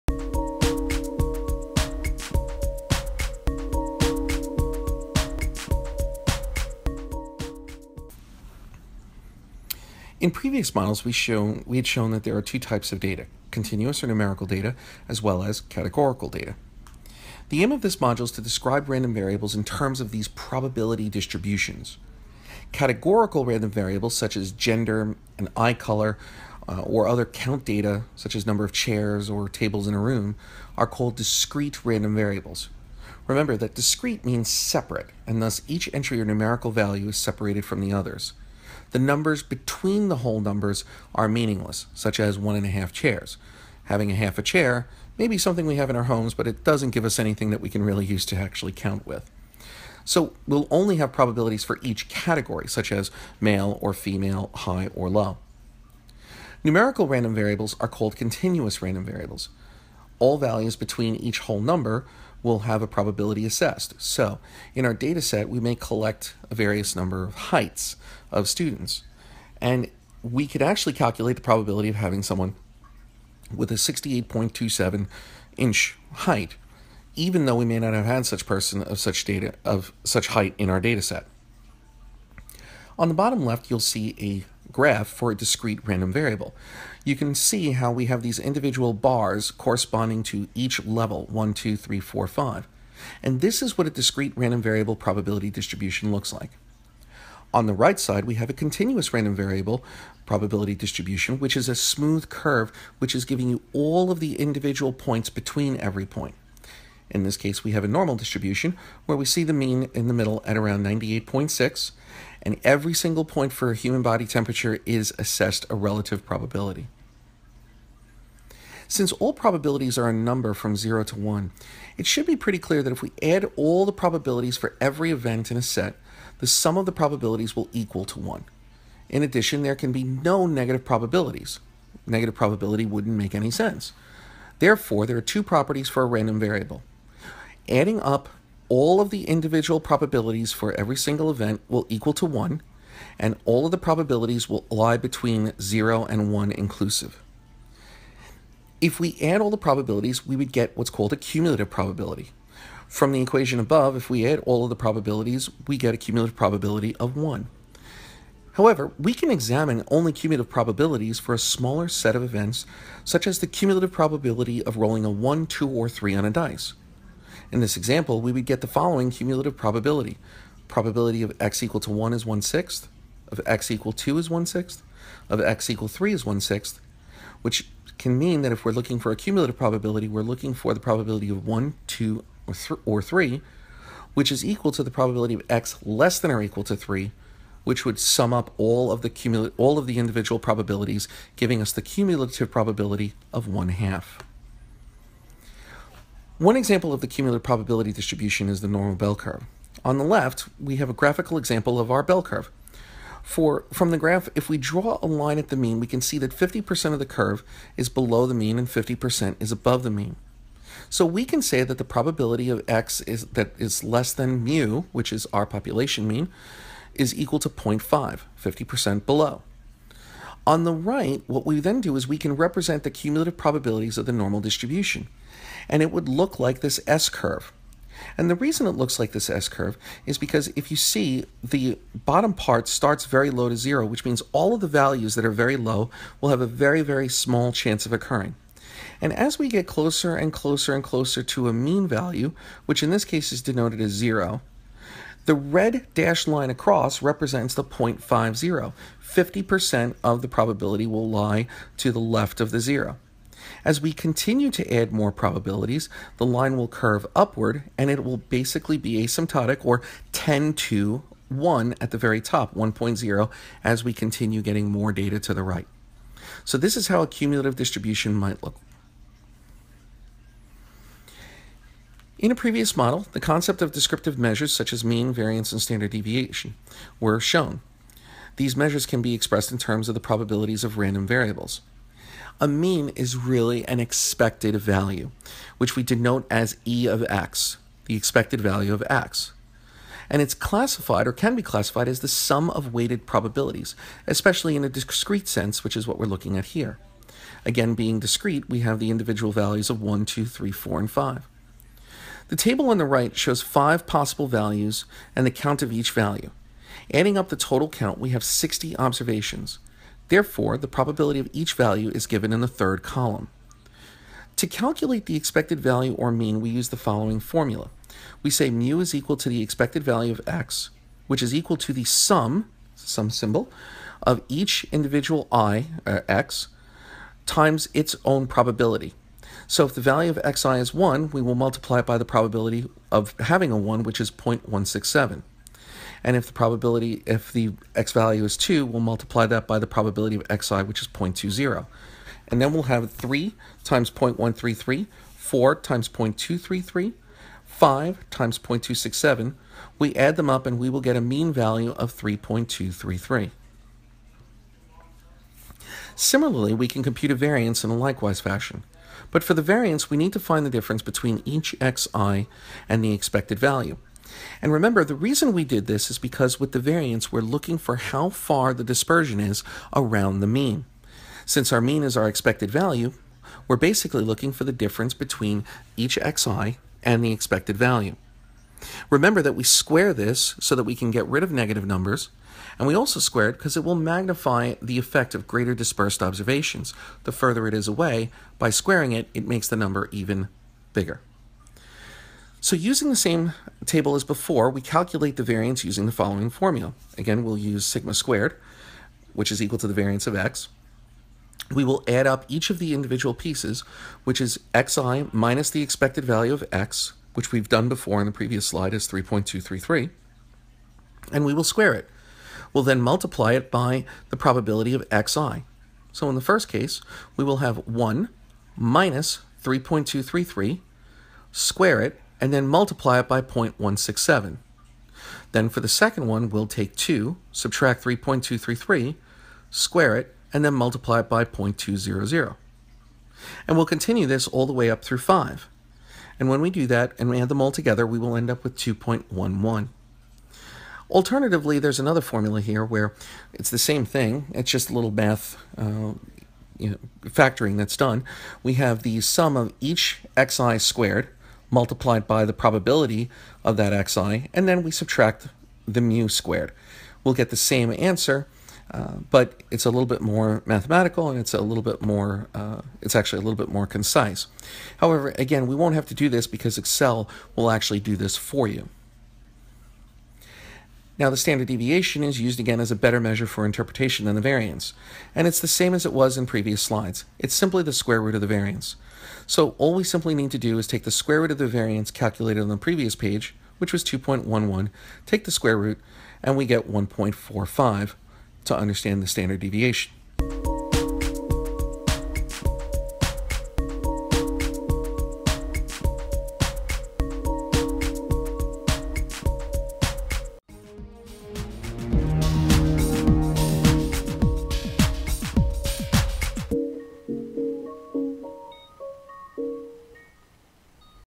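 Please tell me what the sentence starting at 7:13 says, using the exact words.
And we'll continue this all the way up through 5.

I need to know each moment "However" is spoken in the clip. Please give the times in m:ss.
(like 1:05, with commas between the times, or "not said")
2:38, 7:44.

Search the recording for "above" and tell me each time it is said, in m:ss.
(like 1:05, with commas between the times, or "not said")
2:33, 3:29.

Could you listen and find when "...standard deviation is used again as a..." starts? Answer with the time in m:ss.
7:51.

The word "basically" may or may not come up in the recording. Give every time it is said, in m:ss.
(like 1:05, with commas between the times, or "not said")
4:18, 6:13.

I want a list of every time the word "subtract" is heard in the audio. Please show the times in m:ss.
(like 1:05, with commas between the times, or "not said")
7:07, 7:34.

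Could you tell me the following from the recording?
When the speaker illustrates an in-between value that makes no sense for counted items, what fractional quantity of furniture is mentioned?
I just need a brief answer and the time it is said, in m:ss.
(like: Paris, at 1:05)
one and a half chairs, at 0:42.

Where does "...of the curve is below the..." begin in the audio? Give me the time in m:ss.
3:26.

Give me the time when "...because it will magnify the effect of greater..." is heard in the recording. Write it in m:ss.
6:23.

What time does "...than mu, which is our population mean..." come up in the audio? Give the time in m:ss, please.
3:34.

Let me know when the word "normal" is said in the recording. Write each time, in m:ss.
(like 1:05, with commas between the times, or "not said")
1:47, 3:18, 3:44.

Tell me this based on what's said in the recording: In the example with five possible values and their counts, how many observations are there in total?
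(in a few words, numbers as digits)
60.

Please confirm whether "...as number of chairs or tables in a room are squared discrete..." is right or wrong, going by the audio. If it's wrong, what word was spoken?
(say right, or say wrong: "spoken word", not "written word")
wrong: "called", not "squared".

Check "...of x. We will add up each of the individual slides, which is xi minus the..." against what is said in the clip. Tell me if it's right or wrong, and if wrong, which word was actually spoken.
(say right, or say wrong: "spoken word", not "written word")
wrong: "pieces", not "slides".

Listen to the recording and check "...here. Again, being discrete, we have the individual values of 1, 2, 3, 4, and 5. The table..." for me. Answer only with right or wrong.
right.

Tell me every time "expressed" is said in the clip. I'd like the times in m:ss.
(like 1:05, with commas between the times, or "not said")
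4:39.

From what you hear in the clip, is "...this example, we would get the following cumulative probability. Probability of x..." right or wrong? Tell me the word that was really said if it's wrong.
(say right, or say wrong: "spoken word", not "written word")
right.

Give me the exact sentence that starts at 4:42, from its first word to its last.
A mean is really an expected value, which we denote as e of x, the expected value of x.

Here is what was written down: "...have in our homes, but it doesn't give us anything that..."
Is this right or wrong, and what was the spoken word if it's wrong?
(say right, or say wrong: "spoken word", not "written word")
right.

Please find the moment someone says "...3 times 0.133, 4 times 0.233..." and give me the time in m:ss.
5:42.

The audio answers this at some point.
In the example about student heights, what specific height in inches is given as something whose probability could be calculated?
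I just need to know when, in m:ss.
1:13.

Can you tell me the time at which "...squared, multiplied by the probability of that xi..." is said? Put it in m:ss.
7:30.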